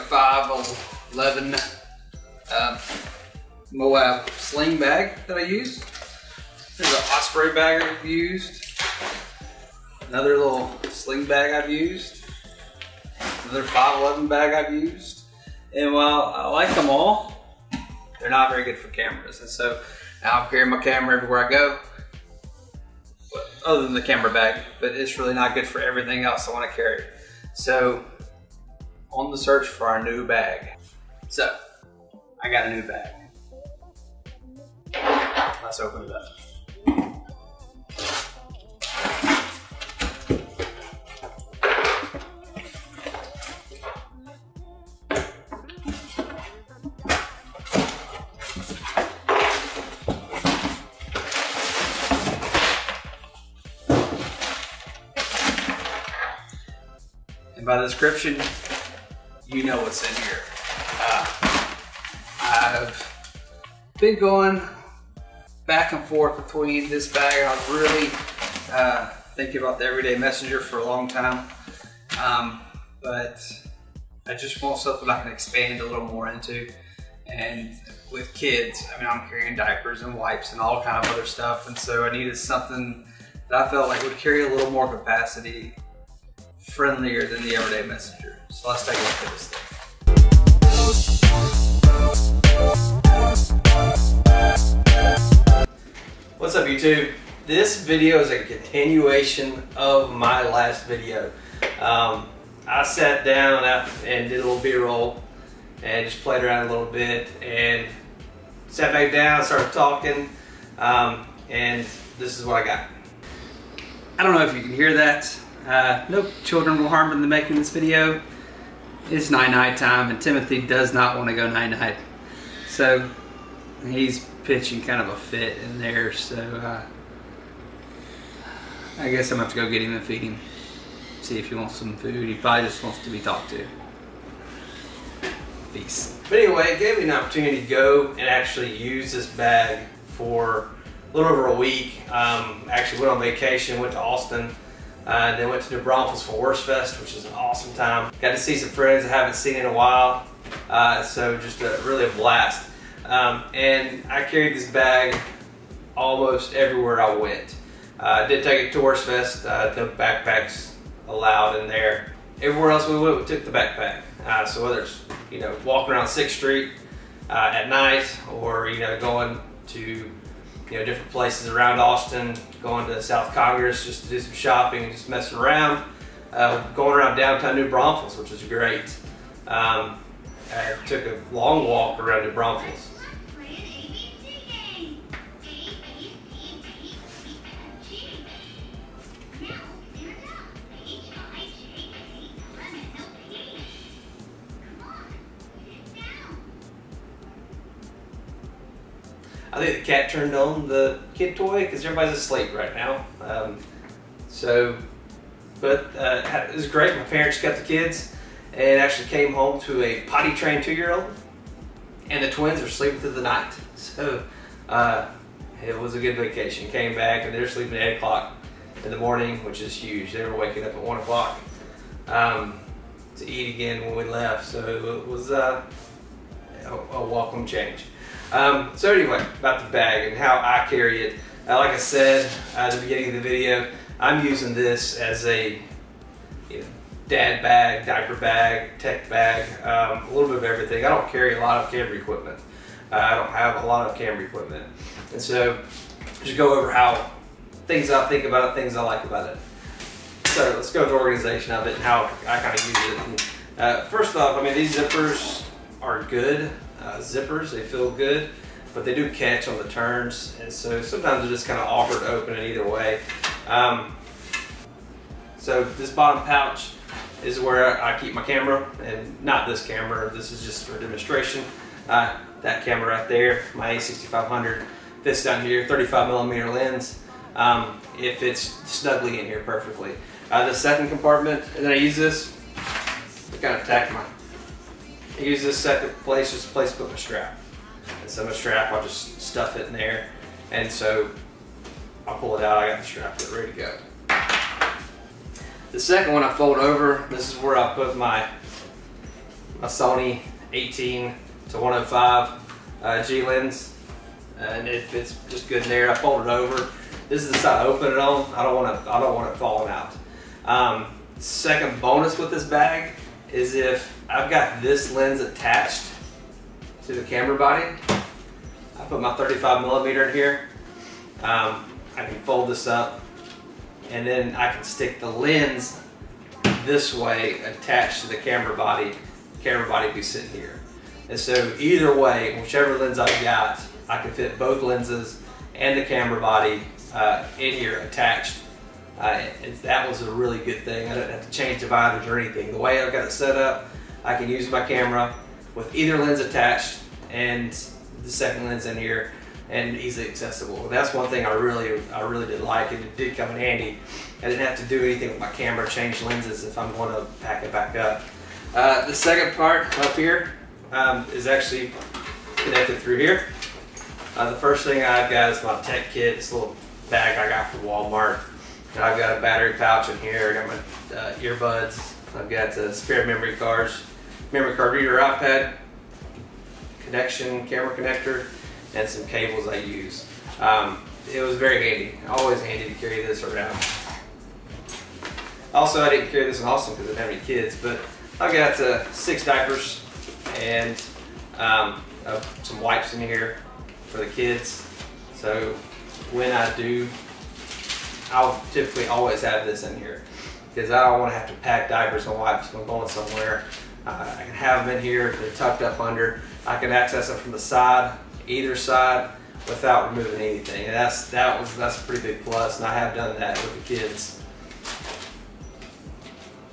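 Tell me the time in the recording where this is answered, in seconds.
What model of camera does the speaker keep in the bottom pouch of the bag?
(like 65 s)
273 s.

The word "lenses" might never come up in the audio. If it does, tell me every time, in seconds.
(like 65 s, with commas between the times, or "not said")
334 s, 356 s.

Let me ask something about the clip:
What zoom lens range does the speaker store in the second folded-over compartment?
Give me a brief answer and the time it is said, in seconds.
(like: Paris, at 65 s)
18 to 105, at 300 s.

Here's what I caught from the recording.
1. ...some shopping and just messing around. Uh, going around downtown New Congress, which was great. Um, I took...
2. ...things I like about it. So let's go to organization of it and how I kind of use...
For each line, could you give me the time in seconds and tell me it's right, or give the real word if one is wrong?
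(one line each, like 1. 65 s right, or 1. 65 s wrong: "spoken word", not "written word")
1. 174 s wrong: "Braunfels", not "Congress"
2. 248 s right.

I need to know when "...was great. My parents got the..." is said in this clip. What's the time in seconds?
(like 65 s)
206 s.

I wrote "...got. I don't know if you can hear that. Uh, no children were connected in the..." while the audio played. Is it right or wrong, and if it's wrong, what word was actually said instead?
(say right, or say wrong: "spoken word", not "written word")
wrong: "harmed", not "connected".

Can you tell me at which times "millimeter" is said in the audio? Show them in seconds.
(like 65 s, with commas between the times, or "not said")
276 s, 319 s.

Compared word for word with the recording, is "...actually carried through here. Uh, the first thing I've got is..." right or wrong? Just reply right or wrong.
wrong.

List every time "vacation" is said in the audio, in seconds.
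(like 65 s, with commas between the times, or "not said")
143 s, 216 s.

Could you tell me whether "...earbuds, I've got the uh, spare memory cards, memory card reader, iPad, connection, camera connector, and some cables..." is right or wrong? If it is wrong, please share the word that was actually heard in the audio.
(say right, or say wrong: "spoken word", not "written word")
right.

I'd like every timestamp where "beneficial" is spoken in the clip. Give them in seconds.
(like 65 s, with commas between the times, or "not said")
not said.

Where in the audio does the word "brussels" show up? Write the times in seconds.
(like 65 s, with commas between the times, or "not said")
not said.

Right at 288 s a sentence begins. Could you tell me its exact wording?
And so my strap, I'll just stuff it in there.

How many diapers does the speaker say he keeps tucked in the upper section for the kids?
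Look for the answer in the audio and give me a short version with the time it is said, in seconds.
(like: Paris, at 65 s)
6, at 388 s.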